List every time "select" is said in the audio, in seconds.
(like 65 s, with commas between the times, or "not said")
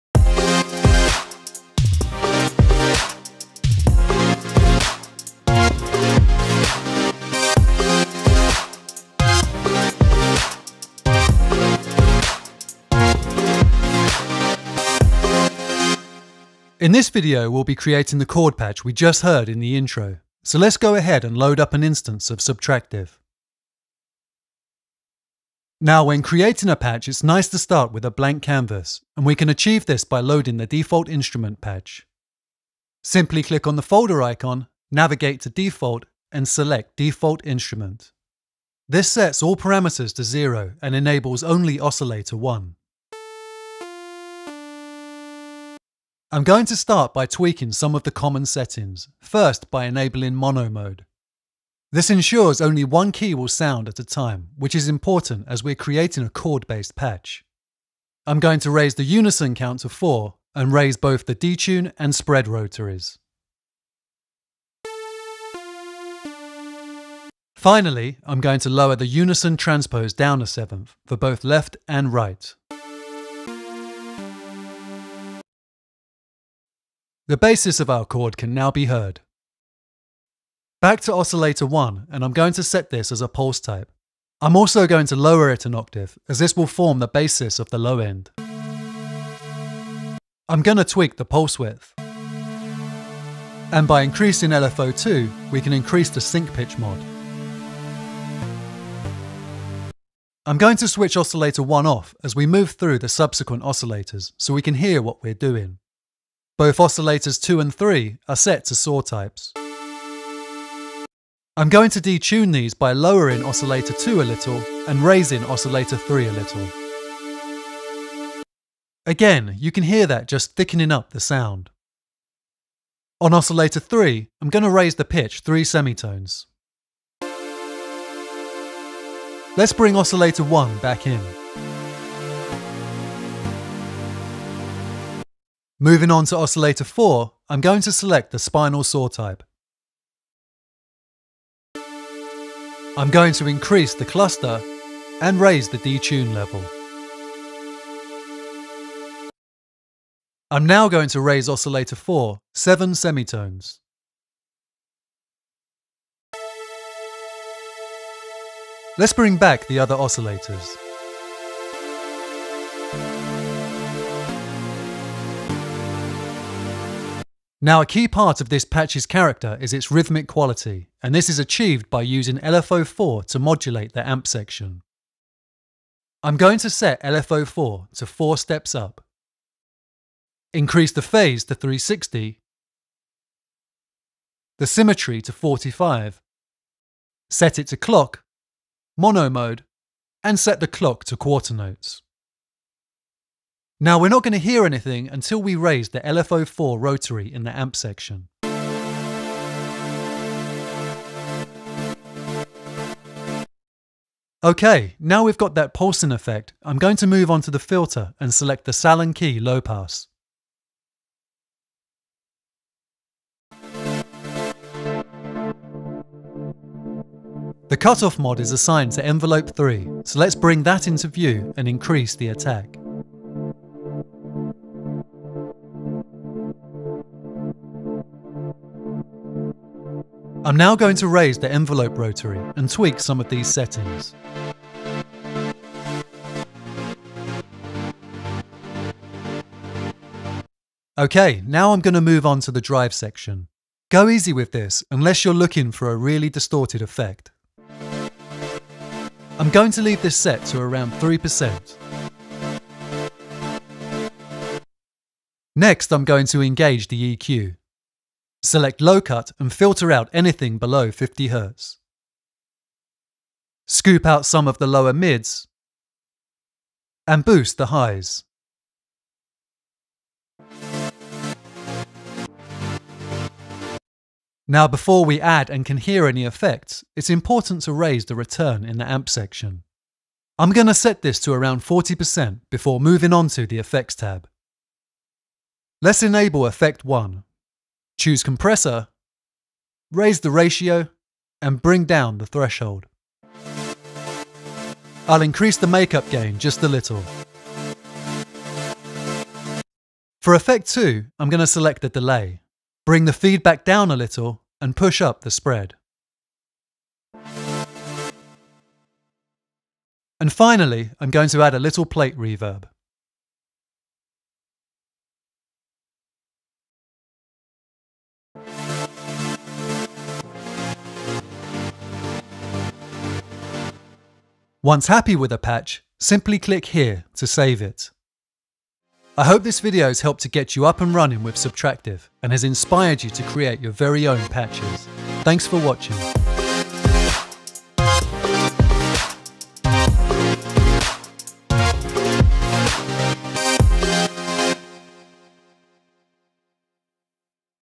36 s, 137 s, 208 s, 258 s, 301 s.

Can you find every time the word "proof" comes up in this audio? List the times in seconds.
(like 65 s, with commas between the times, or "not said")
not said.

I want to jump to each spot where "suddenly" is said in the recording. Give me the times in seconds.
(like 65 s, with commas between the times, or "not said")
not said.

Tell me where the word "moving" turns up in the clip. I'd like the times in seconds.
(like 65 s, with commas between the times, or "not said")
135 s, 282 s.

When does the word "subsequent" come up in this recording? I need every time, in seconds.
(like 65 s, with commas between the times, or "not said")
103 s.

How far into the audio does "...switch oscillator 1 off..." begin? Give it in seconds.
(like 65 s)
100 s.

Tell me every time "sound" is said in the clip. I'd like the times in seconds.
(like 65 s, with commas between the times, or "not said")
53 s, 121 s.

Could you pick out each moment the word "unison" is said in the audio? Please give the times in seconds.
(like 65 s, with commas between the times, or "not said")
59 s, 69 s.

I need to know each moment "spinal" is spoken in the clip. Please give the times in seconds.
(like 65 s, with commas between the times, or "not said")
138 s.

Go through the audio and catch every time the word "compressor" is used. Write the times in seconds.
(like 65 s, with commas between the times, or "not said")
288 s.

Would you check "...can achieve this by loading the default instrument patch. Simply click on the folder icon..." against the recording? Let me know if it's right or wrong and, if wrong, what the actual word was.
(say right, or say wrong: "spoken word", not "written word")
right.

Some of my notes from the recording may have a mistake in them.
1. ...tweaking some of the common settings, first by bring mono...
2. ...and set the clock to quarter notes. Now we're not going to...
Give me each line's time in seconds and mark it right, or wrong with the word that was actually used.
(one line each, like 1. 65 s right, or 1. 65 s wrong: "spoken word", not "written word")
1. 47 s wrong: "enabling", not "bring"
2. 190 s right.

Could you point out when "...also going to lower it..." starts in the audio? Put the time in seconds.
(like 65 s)
84 s.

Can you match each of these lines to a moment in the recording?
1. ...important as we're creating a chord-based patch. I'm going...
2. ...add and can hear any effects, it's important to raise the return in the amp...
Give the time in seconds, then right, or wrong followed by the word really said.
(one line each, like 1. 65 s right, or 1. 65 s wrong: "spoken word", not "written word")
1. 54 s right
2. 275 s right.